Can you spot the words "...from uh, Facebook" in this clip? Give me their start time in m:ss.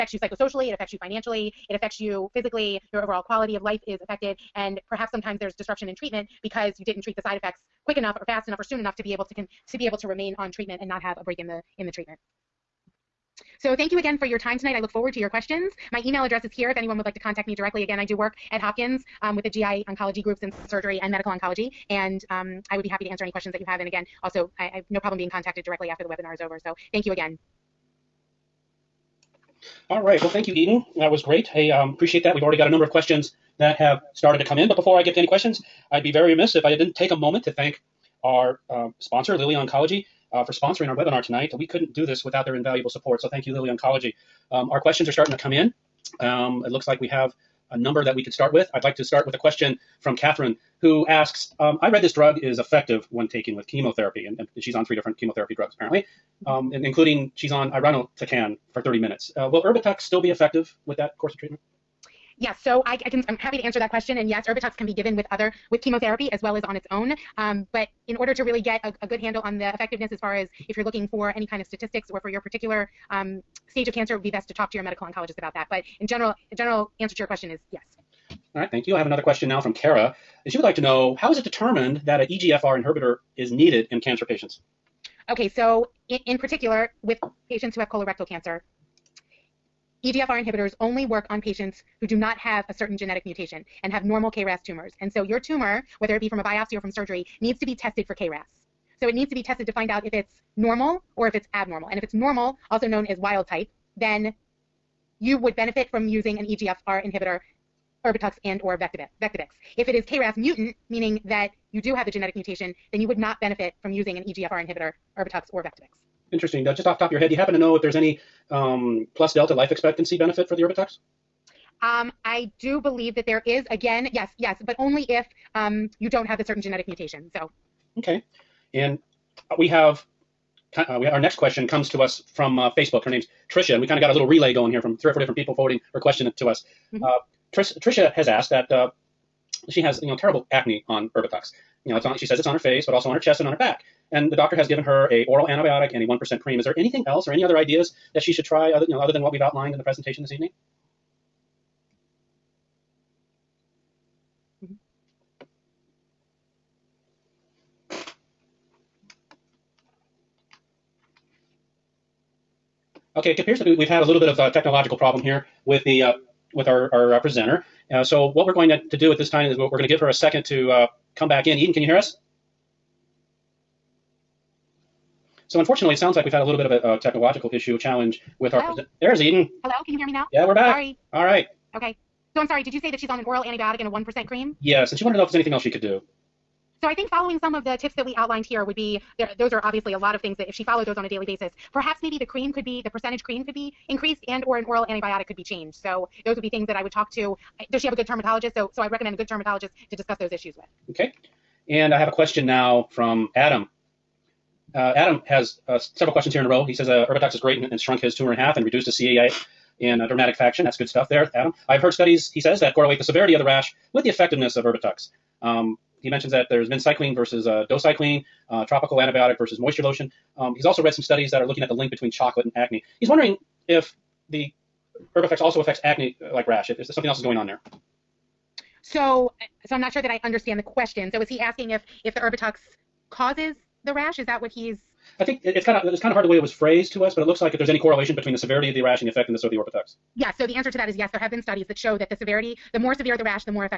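2:12.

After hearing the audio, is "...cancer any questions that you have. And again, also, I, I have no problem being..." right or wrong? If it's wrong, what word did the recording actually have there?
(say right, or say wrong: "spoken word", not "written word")
wrong: "answer", not "cancer".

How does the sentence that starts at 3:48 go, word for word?
So, so I'm not sure that I understand the question.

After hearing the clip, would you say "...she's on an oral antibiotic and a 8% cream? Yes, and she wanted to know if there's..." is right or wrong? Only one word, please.
wrong.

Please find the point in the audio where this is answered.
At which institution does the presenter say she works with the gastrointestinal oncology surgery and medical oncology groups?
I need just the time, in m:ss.
0:18.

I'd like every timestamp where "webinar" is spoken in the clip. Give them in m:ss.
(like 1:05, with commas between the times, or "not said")
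0:26, 0:40.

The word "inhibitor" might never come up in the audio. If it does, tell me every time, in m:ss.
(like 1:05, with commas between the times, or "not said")
1:22, 1:30, 1:47, 1:54.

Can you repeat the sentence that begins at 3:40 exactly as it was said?
Um, he's also read some studies that are looking at the link between chocolate and acne.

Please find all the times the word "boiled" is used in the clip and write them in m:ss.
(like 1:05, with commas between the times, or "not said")
not said.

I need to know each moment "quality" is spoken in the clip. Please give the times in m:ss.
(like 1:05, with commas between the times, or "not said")
0:03.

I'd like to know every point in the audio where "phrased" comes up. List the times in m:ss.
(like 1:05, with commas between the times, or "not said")
3:56.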